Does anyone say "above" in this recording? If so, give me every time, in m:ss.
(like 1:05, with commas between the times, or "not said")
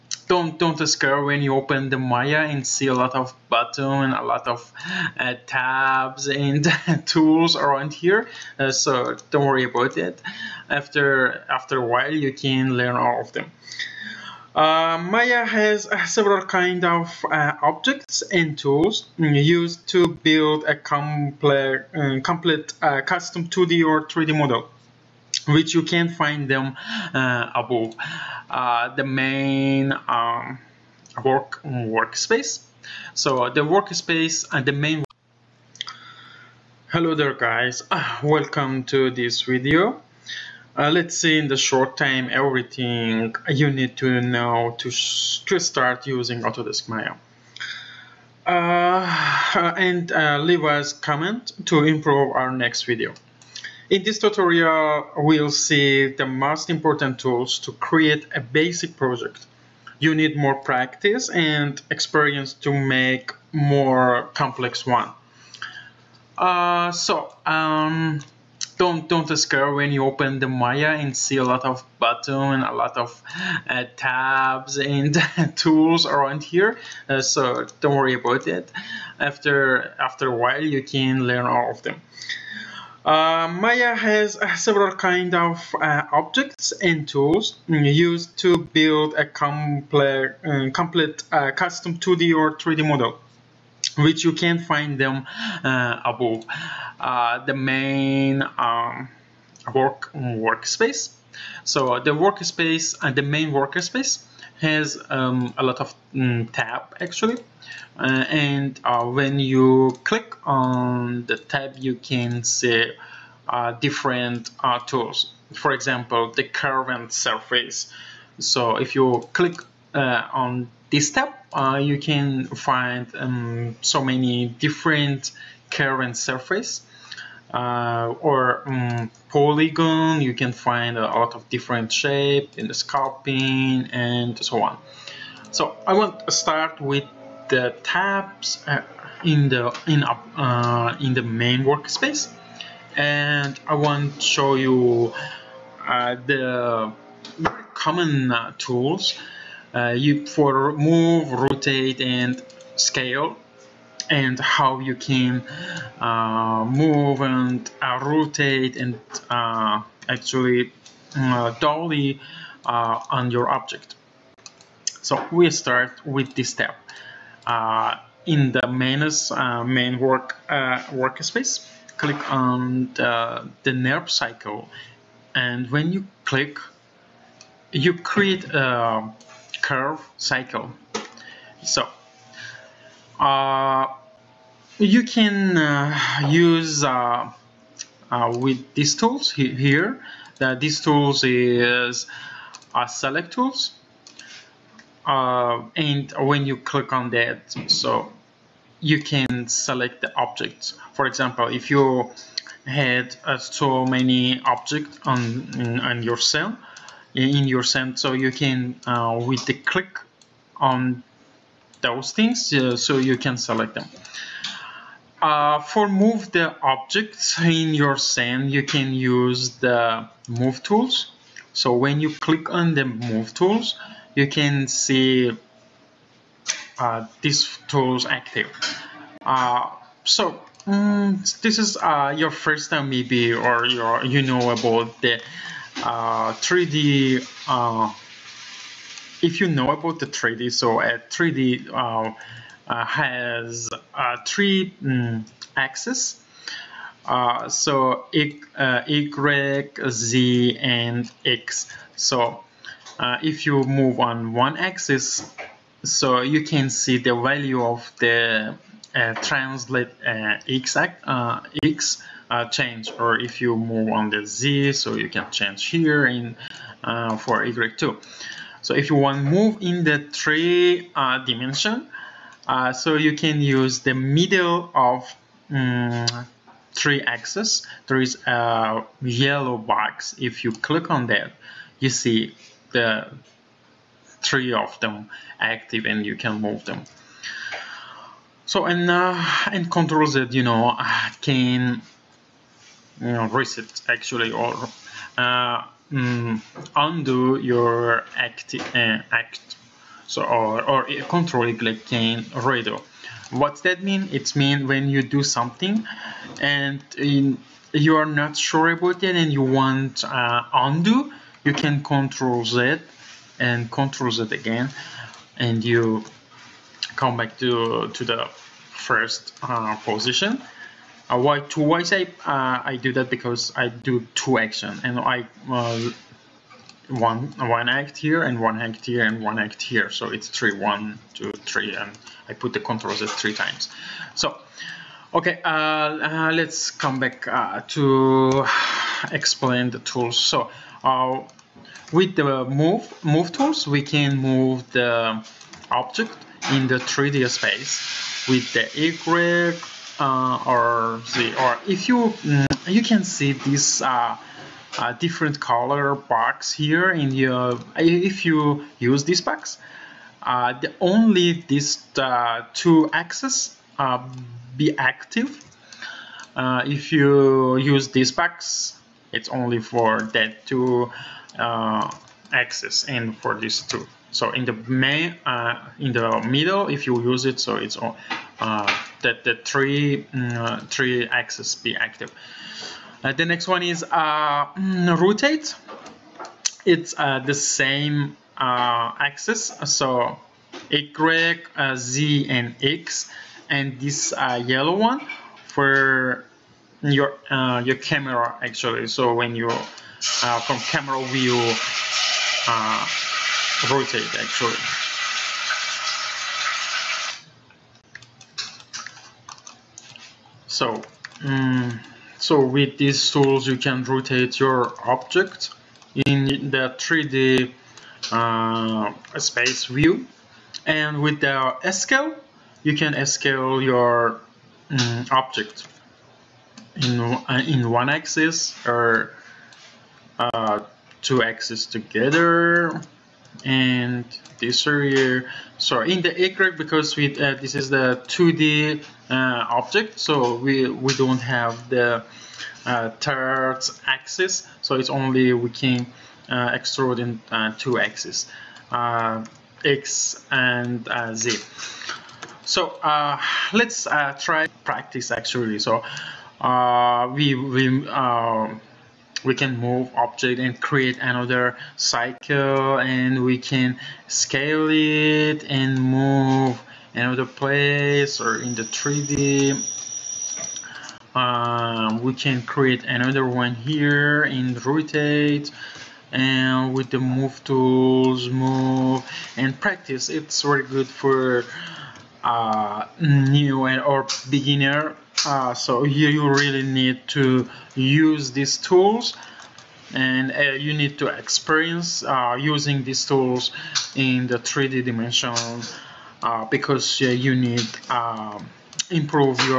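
0:27, 1:36.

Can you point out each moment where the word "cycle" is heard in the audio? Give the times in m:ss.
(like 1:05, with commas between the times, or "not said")
3:00, 7:41.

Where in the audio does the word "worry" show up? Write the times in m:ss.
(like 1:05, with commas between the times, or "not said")
0:09, 1:17.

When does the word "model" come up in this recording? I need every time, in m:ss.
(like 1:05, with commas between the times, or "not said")
0:24, 1:32.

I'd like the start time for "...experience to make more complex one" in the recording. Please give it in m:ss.
1:01.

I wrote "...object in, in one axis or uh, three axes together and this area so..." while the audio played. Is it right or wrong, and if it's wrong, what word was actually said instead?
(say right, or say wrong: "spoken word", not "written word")
wrong: "two", not "three".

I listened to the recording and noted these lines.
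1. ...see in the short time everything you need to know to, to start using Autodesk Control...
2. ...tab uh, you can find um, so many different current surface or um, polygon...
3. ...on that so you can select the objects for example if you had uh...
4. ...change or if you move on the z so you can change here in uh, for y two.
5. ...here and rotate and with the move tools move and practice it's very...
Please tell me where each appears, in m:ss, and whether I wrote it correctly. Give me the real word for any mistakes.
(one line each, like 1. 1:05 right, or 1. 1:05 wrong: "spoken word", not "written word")
1. 0:41 wrong: "Maya", not "Control"
2. 2:01 right
3. 3:16 right
4. 4:22 right
5. 7:53 right.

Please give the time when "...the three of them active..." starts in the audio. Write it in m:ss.
4:42.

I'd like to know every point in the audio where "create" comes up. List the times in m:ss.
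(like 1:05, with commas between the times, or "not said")
0:57, 2:57, 7:40, 7:52.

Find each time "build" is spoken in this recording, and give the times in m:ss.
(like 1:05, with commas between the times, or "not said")
0:20, 1:28.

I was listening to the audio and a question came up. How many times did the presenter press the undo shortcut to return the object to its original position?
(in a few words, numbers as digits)
3.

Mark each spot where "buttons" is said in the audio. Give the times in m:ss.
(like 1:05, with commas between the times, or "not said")
0:03, 1:11.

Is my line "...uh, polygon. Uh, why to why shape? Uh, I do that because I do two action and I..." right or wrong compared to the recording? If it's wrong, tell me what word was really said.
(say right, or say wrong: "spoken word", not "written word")
wrong: "position", not "polygon".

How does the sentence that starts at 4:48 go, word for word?
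So and uh, and Control Z, you know, can you know reset actually or uh, mm, undo your active uh, act.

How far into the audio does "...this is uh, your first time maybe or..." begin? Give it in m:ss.
3:51.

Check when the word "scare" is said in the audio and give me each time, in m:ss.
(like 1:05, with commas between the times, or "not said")
0:00, 1:09.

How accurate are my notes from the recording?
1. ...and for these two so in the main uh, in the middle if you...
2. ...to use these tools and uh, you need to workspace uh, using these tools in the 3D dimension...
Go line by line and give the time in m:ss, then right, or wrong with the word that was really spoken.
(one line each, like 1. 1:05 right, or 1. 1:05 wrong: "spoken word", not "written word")
1. 6:12 right
2. 8:07 wrong: "experience", not "workspace".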